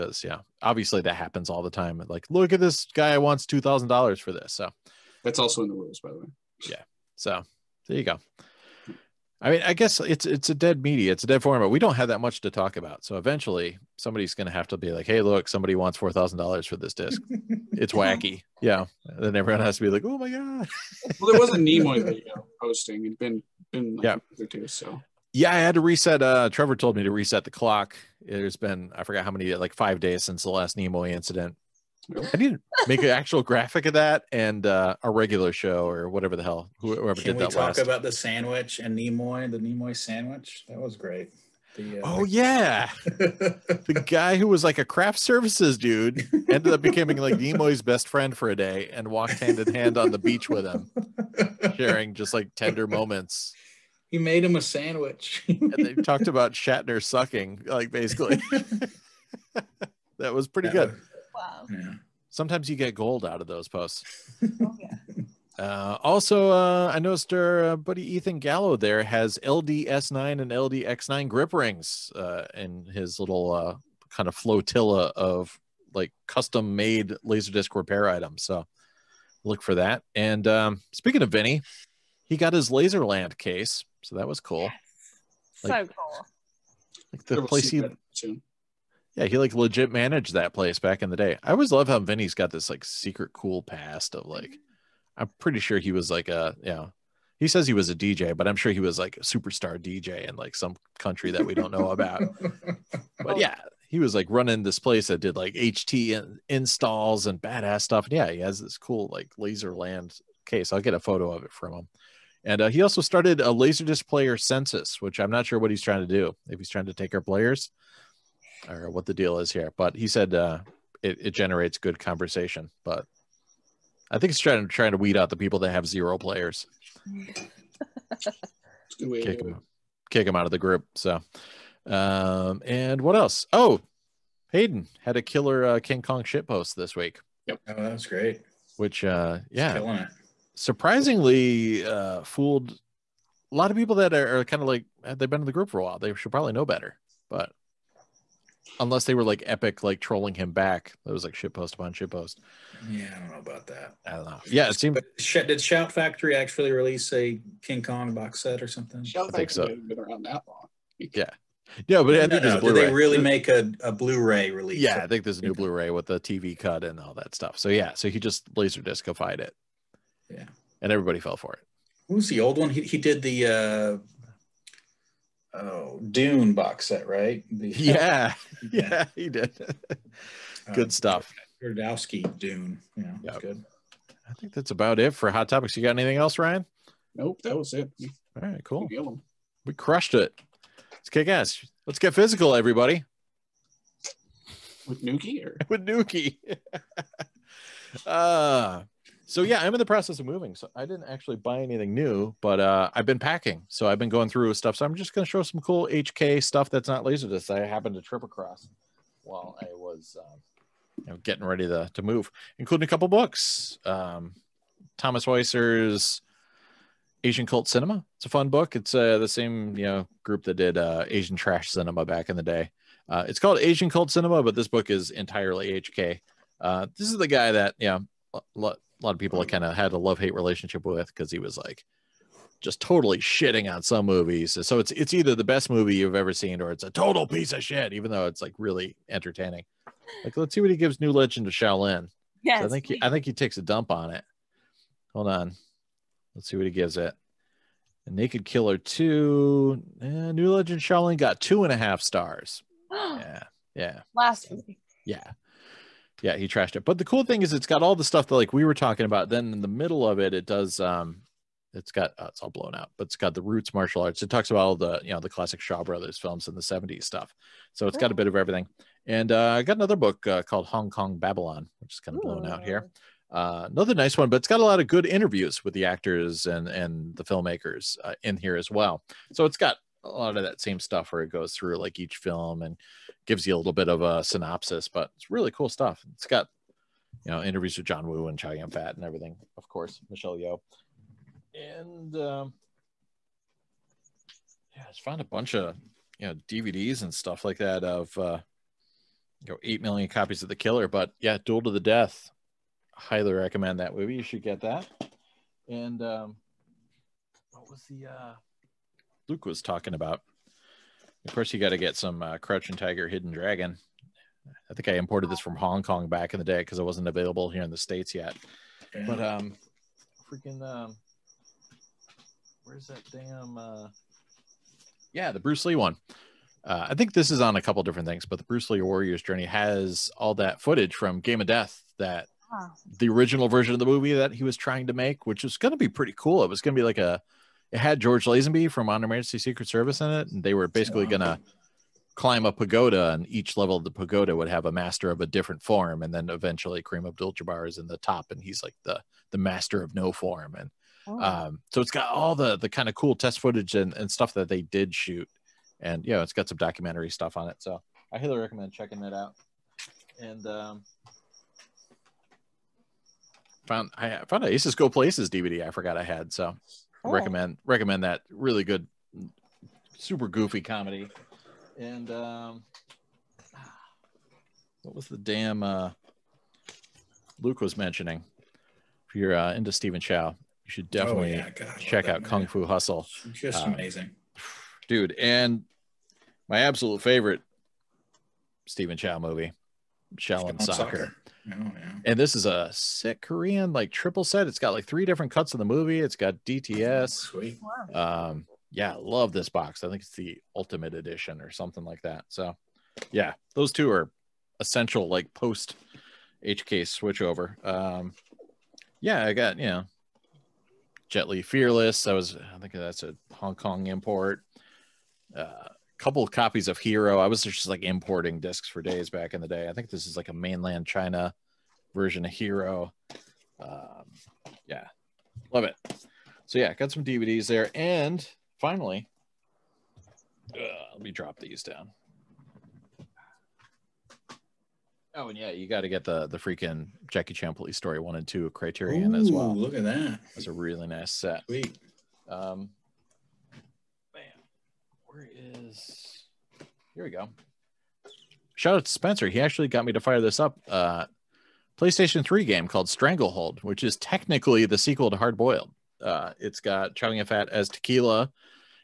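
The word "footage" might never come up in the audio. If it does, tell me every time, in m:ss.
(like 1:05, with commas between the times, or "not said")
5:30, 5:53.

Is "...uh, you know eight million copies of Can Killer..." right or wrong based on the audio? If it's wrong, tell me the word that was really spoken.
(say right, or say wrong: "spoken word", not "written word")
wrong: "The", not "Can".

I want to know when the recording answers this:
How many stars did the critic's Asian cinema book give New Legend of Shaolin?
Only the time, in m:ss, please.
4:11.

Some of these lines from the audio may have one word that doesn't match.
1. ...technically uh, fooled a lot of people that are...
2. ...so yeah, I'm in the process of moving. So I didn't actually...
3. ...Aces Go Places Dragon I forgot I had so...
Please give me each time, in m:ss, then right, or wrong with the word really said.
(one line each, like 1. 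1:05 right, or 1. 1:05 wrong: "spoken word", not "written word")
1. 2:20 wrong: "surprisingly", not "technically"
2. 3:19 right
3. 6:04 wrong: "DVD", not "Dragon".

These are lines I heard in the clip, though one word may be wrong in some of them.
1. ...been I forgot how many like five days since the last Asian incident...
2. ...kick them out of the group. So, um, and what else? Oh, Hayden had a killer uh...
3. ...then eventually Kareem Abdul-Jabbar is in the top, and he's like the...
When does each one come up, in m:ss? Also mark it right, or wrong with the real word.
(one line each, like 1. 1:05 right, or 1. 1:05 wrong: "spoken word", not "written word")
1. 0:28 wrong: "Nimoy", not "Asian"
2. 2:10 right
3. 5:46 right.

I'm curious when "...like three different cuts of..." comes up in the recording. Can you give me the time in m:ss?
6:34.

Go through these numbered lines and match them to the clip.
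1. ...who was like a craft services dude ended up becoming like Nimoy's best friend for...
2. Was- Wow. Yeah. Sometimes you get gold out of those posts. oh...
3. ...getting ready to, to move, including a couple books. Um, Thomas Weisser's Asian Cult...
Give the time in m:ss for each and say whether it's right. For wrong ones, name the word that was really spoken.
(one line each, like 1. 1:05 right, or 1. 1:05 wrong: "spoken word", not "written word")
1. 0:44 right
2. 1:00 right
3. 3:31 right.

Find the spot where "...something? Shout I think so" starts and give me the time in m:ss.
2:38.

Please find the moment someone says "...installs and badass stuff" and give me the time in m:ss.
1:46.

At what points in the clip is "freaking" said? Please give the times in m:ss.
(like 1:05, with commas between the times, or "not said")
5:20, 7:16.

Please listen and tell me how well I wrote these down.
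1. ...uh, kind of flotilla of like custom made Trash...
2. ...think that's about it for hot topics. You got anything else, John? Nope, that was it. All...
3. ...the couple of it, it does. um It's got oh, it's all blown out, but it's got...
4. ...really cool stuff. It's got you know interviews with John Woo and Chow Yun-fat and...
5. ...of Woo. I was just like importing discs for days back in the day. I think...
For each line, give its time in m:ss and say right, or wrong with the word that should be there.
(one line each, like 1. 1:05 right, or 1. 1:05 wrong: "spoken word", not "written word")
1. 1:13 wrong: "Laserdisc", not "Trash"
2. 3:04 wrong: "Ryan", not "John"
3. 4:19 wrong: "middle", not "couple"
4. 4:45 right
5. 6:56 wrong: "Hero", not "Woo".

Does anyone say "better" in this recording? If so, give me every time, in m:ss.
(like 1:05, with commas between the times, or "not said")
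2:26.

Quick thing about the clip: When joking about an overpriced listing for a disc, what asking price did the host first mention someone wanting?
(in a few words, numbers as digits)
$2000.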